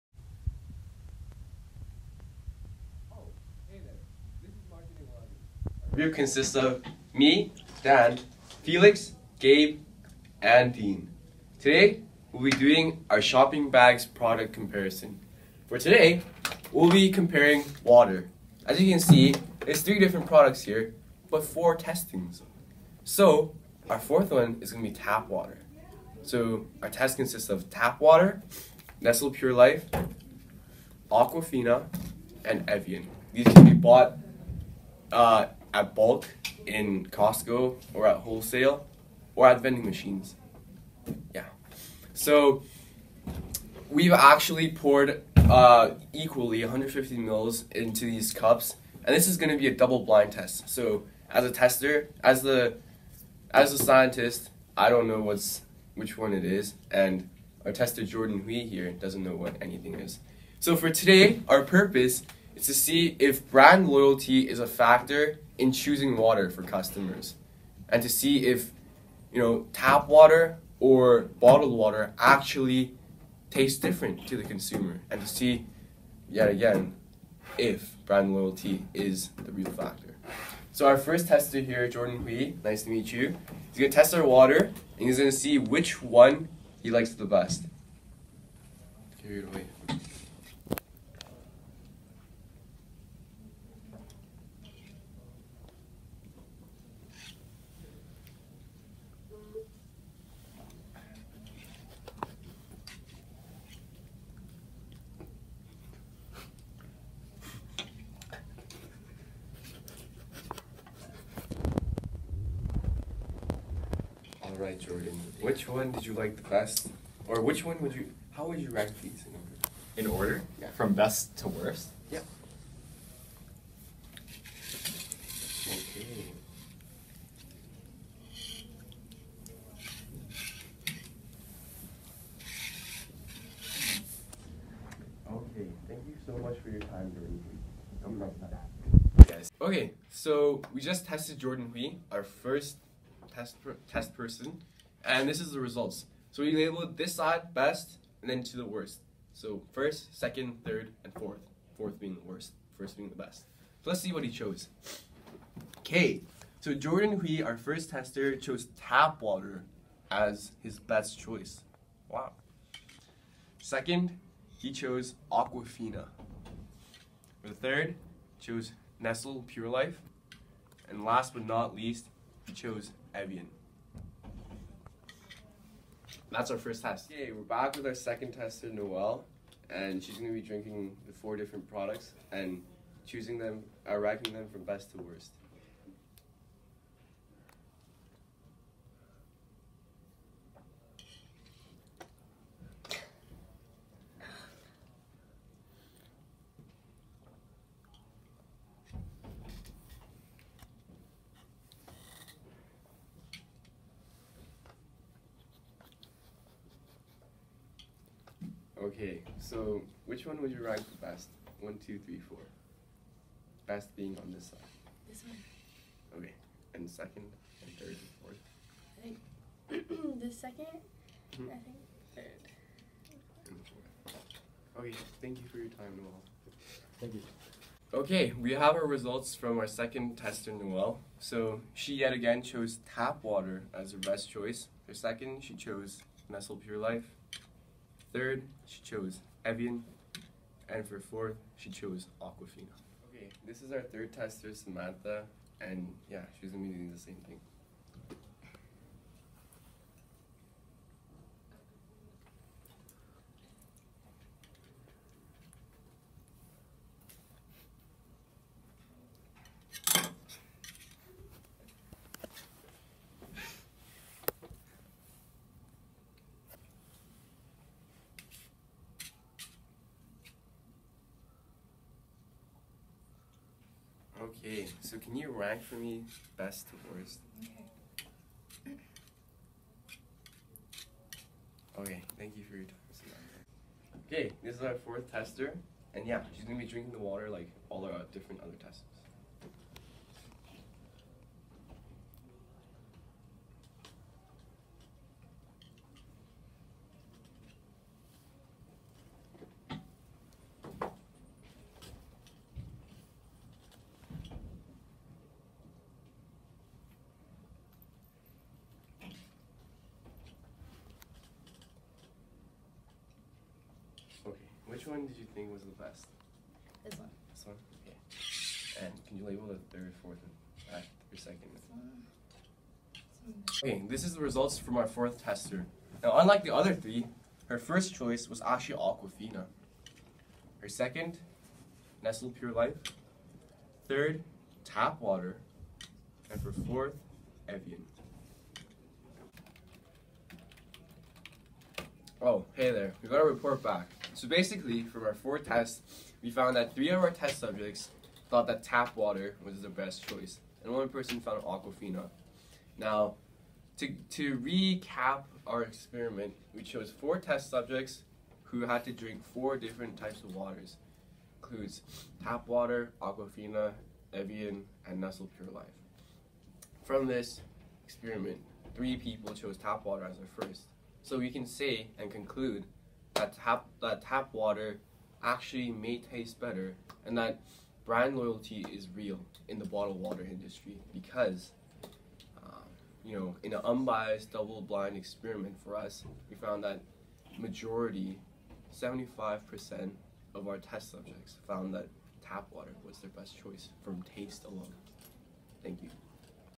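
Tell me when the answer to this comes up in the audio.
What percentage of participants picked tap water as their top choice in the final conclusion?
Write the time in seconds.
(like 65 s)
388 s.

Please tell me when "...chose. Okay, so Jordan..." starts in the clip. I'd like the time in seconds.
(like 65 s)
154 s.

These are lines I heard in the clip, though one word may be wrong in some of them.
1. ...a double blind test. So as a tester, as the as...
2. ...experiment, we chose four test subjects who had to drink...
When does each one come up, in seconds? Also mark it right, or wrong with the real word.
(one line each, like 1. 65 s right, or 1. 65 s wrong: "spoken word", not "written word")
1. 49 s right
2. 355 s right.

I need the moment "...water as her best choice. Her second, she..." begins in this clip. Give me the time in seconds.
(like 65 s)
233 s.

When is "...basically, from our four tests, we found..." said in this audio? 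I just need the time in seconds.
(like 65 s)
344 s.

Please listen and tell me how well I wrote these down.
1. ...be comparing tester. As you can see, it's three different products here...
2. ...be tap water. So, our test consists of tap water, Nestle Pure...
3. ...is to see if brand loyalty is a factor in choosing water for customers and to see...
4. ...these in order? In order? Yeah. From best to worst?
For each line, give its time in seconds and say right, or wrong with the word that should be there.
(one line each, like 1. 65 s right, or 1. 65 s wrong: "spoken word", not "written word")
1. 16 s wrong: "water", not "tester"
2. 24 s right
3. 62 s right
4. 119 s right.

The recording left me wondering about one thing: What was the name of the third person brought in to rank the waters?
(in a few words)
Samantha.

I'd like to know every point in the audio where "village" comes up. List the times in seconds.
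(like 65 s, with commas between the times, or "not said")
not said.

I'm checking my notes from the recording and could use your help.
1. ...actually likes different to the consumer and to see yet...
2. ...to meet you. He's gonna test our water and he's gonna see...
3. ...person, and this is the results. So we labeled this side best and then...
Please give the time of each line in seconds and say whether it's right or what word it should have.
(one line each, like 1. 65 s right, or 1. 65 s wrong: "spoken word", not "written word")
1. 72 s wrong: "tastes", not "likes"
2. 82 s right
3. 144 s right.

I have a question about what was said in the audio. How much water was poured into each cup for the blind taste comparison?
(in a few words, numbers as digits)
150 mL.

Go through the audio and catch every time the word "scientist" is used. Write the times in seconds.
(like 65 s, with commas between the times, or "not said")
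53 s.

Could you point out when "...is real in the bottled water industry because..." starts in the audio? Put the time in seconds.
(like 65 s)
378 s.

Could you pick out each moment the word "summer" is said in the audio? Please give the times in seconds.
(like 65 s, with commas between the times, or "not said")
not said.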